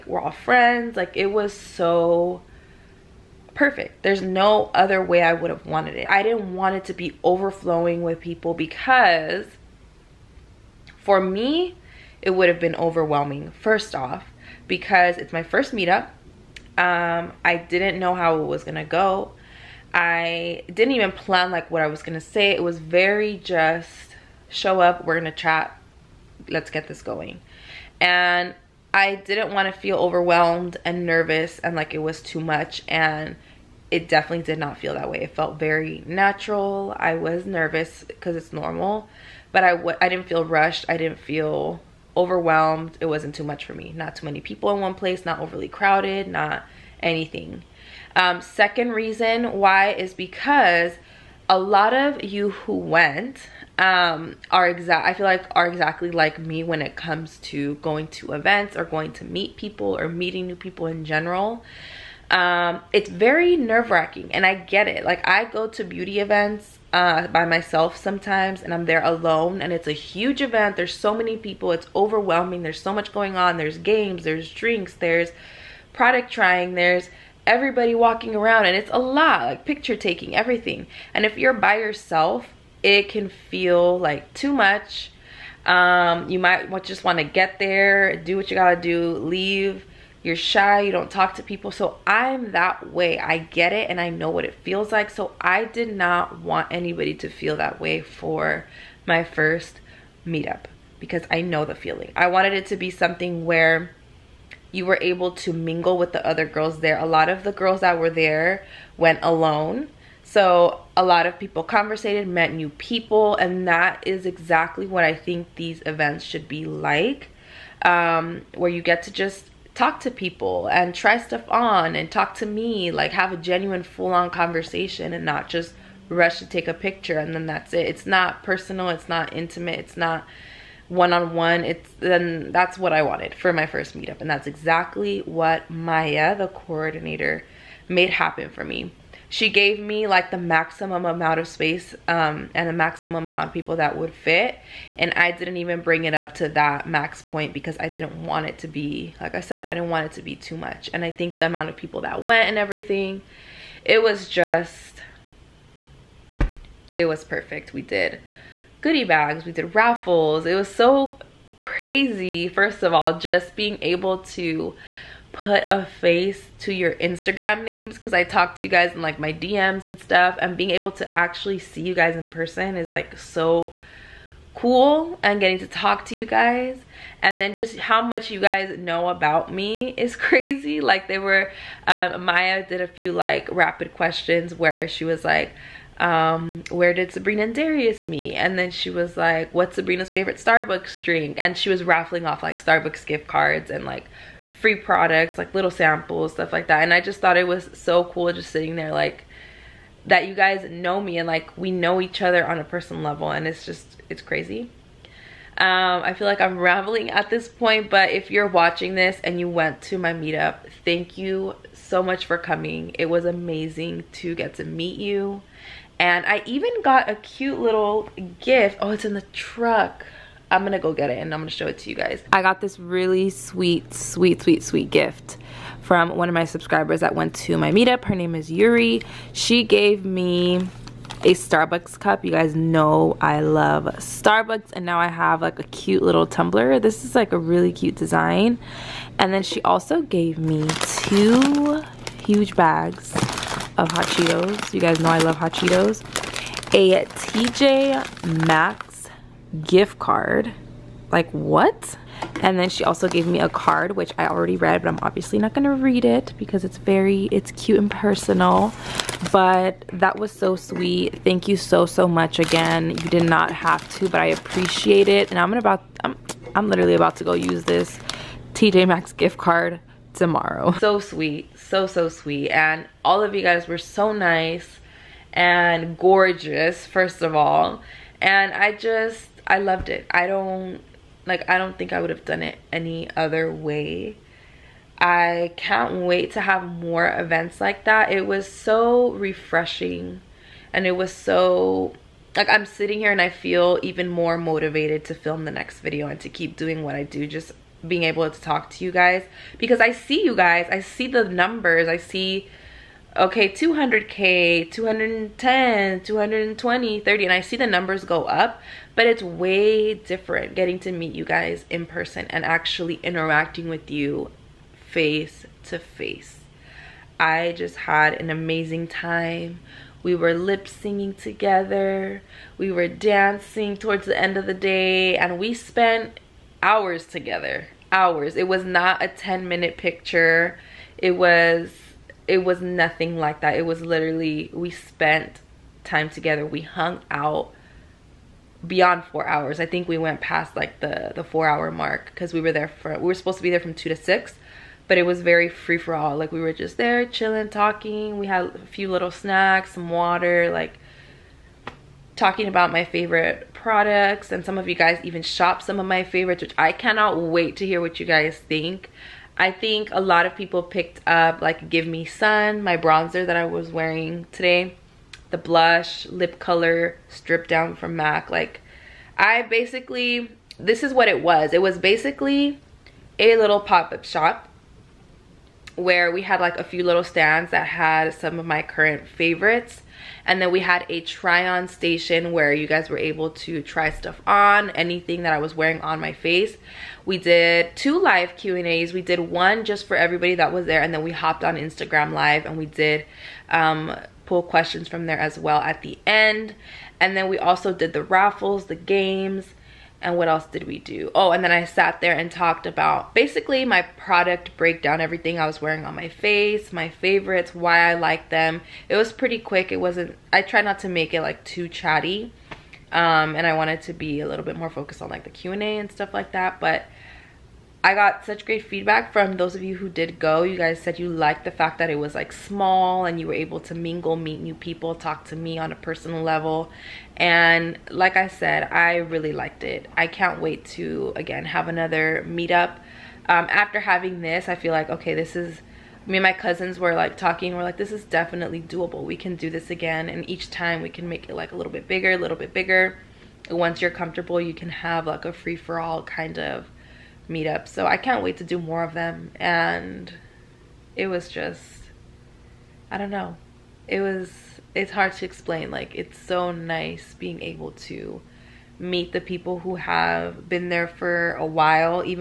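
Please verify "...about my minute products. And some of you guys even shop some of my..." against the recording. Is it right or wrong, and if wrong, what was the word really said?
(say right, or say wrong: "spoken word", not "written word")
wrong: "favorite", not "minute".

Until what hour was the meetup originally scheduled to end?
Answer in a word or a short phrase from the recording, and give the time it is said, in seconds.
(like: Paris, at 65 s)
6, at 343 s.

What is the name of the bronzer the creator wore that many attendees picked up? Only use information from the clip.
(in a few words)
Give Me Sun.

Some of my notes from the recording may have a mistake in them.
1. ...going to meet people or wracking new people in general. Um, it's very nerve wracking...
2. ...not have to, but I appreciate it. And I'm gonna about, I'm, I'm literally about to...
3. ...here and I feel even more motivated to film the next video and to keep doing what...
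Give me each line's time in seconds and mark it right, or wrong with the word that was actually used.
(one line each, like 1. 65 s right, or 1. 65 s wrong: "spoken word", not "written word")
1. 58 s wrong: "meeting", not "wracking"
2. 263 s right
3. 292 s right.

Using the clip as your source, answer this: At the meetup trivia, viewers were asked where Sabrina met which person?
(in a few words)
Darius.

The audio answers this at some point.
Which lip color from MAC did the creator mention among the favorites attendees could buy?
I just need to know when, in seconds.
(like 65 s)
367 s.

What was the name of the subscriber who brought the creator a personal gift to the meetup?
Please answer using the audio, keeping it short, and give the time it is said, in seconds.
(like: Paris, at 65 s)
Yuri, at 228 s.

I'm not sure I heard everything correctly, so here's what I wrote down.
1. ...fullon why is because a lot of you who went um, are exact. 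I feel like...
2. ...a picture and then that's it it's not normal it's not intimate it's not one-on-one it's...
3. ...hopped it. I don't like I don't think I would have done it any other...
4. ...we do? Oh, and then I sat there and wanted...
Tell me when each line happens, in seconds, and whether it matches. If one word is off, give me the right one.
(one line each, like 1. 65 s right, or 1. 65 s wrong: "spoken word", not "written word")
1. 48 s wrong: "reason", not "fullon"
2. 126 s wrong: "personal", not "normal"
3. 279 s wrong: "loved", not "hopped"
4. 400 s wrong: "talked", not "wanted".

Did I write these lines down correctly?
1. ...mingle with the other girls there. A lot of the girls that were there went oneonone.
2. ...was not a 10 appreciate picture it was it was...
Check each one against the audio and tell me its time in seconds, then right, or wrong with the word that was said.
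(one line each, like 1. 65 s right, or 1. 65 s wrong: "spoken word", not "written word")
1. 105 s wrong: "alone", not "oneonone"
2. 328 s wrong: "minute", not "appreciate".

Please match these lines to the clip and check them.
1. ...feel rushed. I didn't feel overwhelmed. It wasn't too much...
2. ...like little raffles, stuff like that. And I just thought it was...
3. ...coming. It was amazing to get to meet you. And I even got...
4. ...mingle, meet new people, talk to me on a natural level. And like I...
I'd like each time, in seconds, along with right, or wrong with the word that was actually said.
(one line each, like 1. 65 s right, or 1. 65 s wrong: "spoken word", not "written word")
1. 40 s right
2. 195 s wrong: "samples", not "raffles"
3. 212 s right
4. 423 s wrong: "personal", not "natural".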